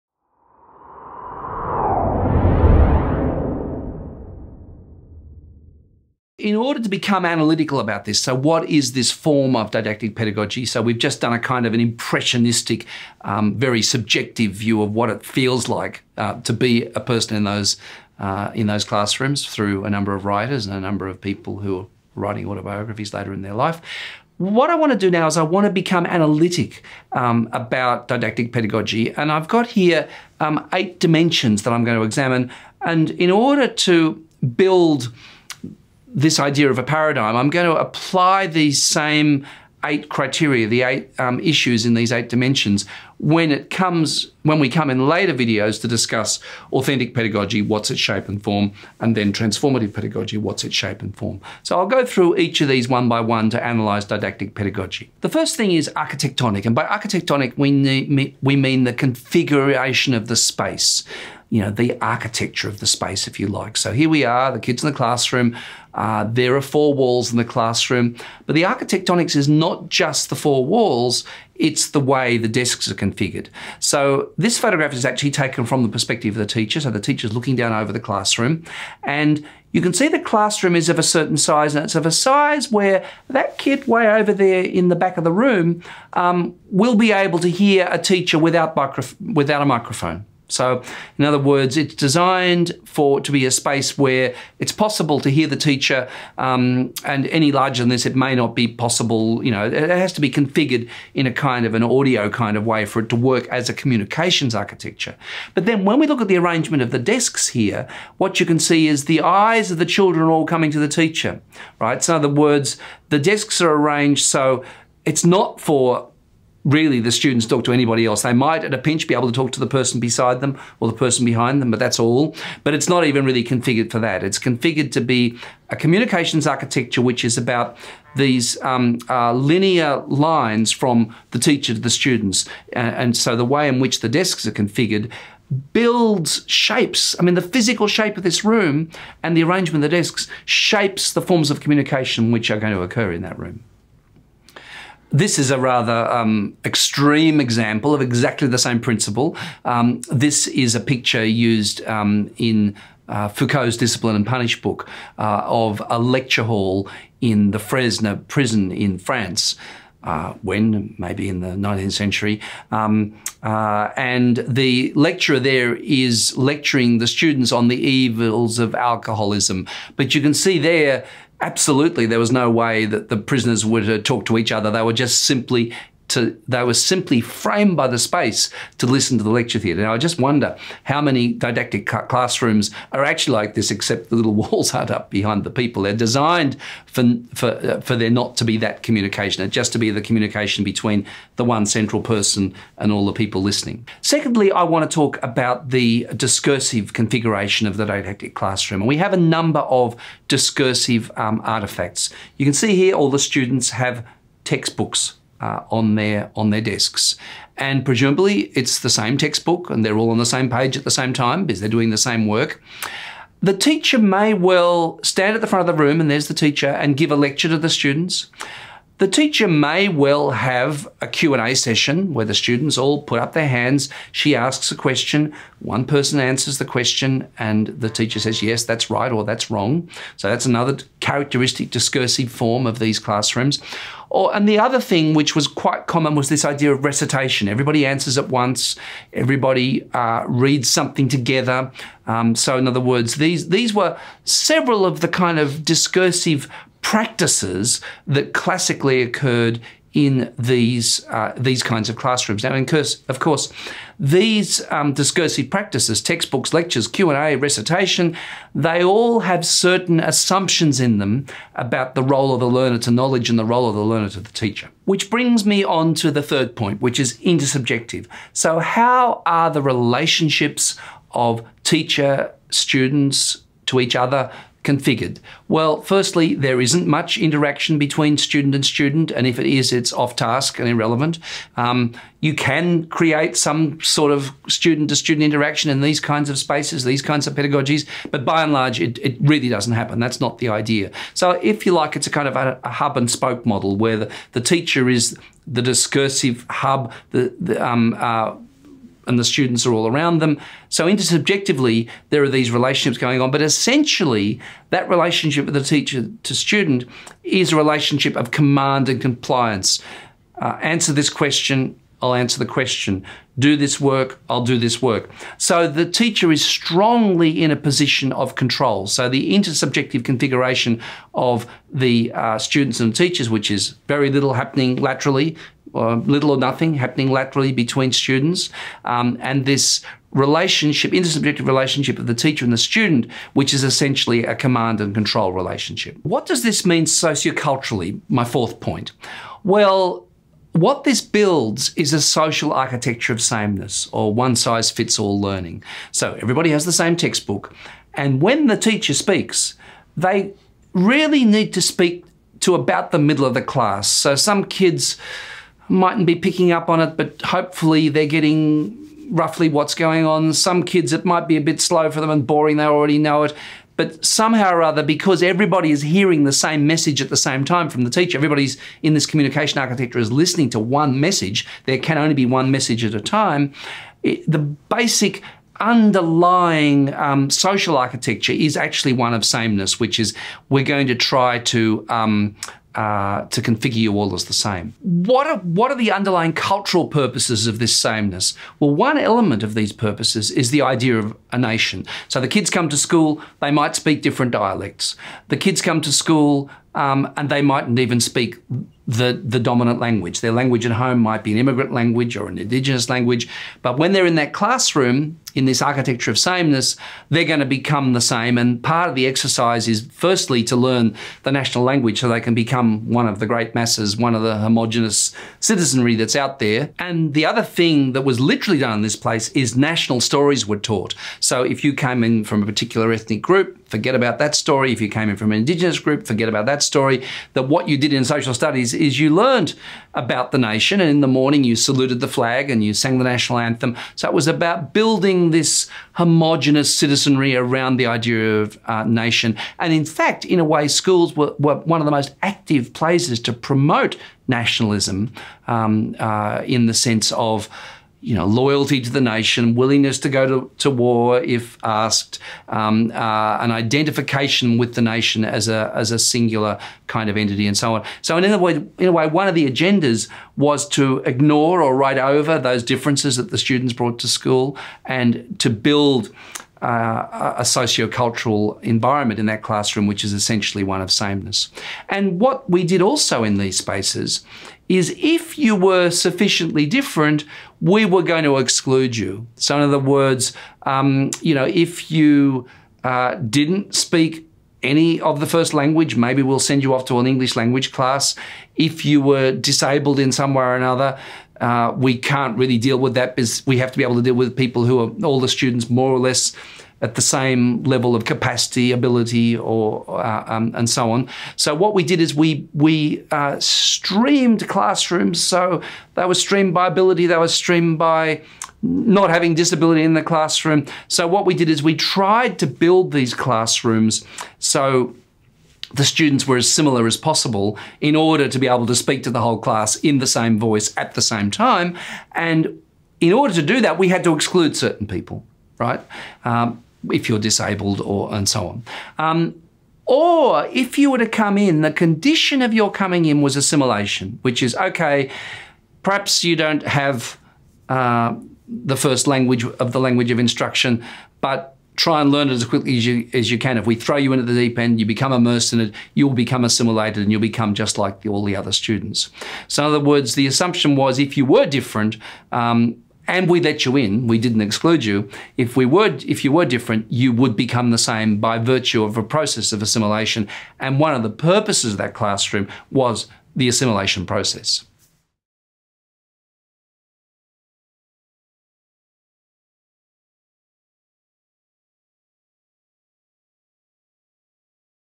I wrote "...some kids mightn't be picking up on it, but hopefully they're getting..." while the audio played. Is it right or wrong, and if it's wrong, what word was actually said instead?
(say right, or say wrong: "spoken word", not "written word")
right.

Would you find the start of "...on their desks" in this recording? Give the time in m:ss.
3:26.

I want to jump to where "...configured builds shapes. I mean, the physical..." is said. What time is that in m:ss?
2:14.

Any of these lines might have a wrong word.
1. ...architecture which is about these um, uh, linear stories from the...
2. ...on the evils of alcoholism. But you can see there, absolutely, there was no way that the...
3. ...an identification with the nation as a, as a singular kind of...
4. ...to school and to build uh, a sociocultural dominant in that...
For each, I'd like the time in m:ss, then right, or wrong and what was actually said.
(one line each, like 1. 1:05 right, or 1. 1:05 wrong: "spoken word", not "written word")
1. 2:06 wrong: "lines", not "stories"
2. 2:47 right
3. 7:33 right
4. 7:43 wrong: "environment", not "dominant".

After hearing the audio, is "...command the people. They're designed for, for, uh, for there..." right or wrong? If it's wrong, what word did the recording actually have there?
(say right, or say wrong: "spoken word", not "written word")
wrong: "behind", not "command".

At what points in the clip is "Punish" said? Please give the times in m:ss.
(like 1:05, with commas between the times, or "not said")
2:34.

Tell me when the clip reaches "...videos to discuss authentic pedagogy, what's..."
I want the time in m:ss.
0:45.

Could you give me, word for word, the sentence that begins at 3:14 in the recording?
Secondly, I want to talk about the discursive configuration of the didactic classroom.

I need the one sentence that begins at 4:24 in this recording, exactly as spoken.
Which brings me on to the third point, which is intersubjective.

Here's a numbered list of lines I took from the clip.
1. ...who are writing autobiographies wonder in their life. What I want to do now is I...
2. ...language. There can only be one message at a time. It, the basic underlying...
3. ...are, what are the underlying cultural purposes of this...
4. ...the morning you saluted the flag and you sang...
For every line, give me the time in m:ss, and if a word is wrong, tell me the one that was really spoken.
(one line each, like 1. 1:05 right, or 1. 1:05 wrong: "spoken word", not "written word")
1. 0:21 wrong: "later", not "wonder"
2. 6:10 wrong: "message", not "language"
3. 6:25 right
4. 7:10 right.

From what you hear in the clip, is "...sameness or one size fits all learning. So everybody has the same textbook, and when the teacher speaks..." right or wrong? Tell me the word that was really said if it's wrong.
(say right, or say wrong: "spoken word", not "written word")
right.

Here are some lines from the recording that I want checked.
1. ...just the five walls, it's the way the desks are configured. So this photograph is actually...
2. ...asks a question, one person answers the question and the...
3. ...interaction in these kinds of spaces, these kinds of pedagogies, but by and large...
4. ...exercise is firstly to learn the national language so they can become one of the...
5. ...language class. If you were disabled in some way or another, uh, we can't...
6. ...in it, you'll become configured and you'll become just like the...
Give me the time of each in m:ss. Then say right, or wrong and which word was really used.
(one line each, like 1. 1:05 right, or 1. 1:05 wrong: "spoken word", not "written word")
1. 1:09 wrong: "four", not "five"
2. 3:44 right
3. 4:45 right
4. 6:49 right
5. 8:07 right
6. 9:05 wrong: "assimilated", not "configured".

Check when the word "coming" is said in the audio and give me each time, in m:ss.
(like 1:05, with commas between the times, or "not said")
1:50, 8:52.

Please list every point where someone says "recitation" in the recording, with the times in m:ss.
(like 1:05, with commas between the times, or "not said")
3:56, 4:17.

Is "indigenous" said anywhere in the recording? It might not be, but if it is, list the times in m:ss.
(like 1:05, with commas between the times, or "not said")
6:42, 7:05.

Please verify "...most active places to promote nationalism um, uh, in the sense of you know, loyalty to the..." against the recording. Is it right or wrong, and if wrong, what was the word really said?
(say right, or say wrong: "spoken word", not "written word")
right.